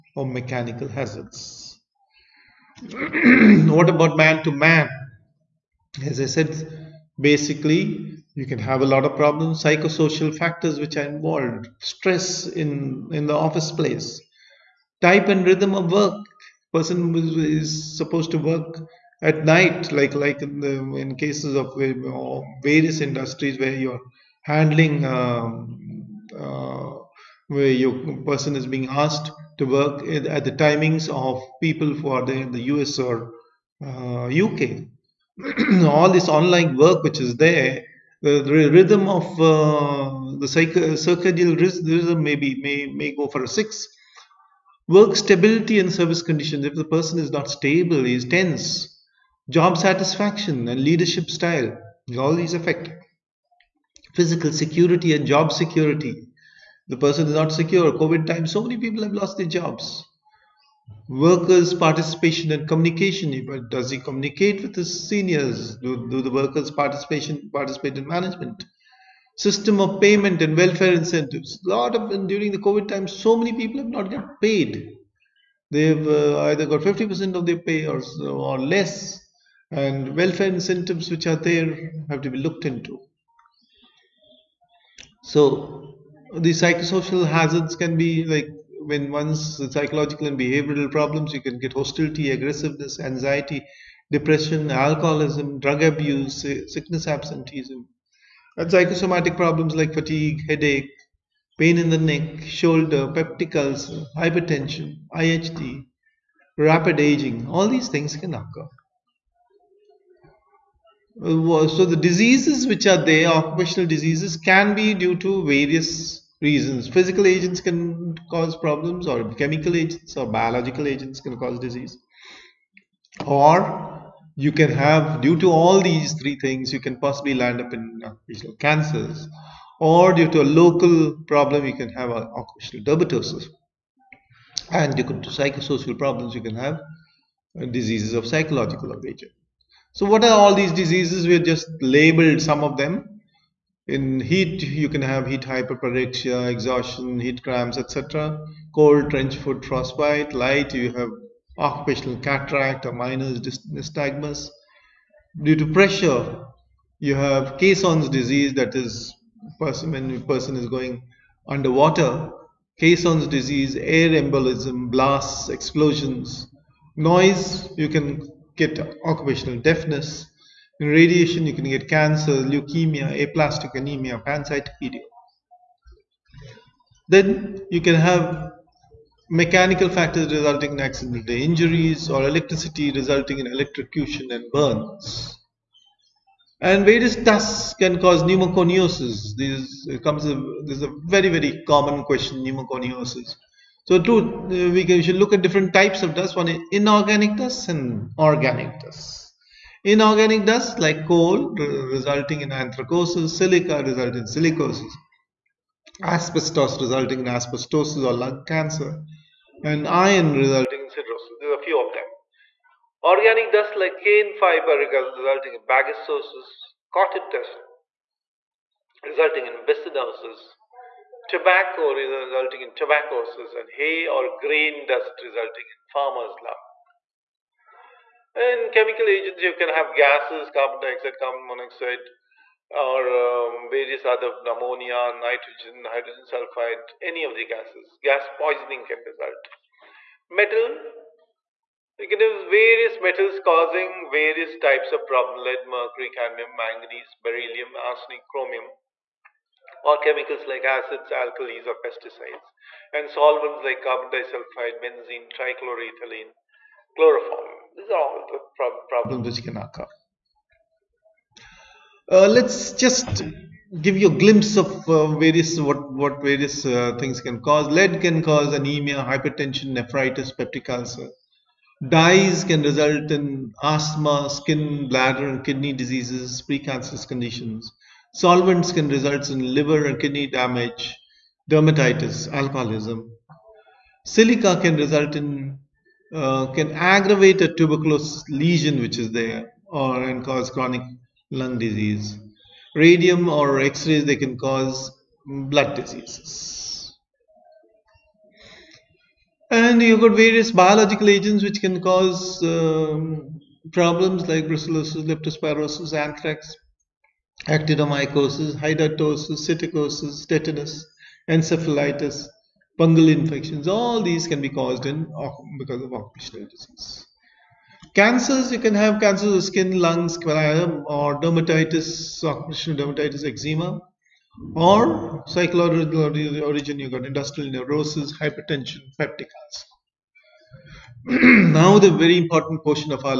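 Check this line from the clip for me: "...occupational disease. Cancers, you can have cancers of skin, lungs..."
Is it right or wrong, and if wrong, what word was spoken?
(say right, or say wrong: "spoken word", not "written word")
right.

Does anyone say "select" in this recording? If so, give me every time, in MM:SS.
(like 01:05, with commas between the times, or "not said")
not said.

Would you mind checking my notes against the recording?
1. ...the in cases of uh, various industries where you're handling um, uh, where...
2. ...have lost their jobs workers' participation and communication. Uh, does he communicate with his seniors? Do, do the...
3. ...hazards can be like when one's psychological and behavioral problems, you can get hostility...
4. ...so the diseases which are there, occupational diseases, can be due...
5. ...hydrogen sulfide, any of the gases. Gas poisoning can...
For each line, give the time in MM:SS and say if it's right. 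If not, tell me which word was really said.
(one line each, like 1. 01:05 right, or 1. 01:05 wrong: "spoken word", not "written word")
1. 00:20 right
2. 00:59 right
3. 01:27 right
4. 01:51 right
5. 03:55 right.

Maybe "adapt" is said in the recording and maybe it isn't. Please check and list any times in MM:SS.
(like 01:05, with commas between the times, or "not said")
not said.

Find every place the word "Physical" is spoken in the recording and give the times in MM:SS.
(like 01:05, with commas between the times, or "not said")
00:54, 01:56.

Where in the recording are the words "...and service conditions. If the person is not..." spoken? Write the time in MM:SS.
00:45.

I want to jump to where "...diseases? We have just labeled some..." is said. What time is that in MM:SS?
02:20.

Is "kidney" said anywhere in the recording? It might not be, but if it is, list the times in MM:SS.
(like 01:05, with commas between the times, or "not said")
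04:35, 04:40.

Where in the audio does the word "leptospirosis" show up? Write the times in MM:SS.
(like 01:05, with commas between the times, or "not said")
05:05.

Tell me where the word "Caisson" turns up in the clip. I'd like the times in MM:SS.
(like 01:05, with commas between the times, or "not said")
02:37, 02:42.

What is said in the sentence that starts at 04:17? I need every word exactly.
These are all the prob problems which can occur.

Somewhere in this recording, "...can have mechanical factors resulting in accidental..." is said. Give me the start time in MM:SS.
02:57.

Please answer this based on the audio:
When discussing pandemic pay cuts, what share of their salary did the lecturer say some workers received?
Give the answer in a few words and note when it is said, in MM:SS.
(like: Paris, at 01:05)
50%, at 01:16.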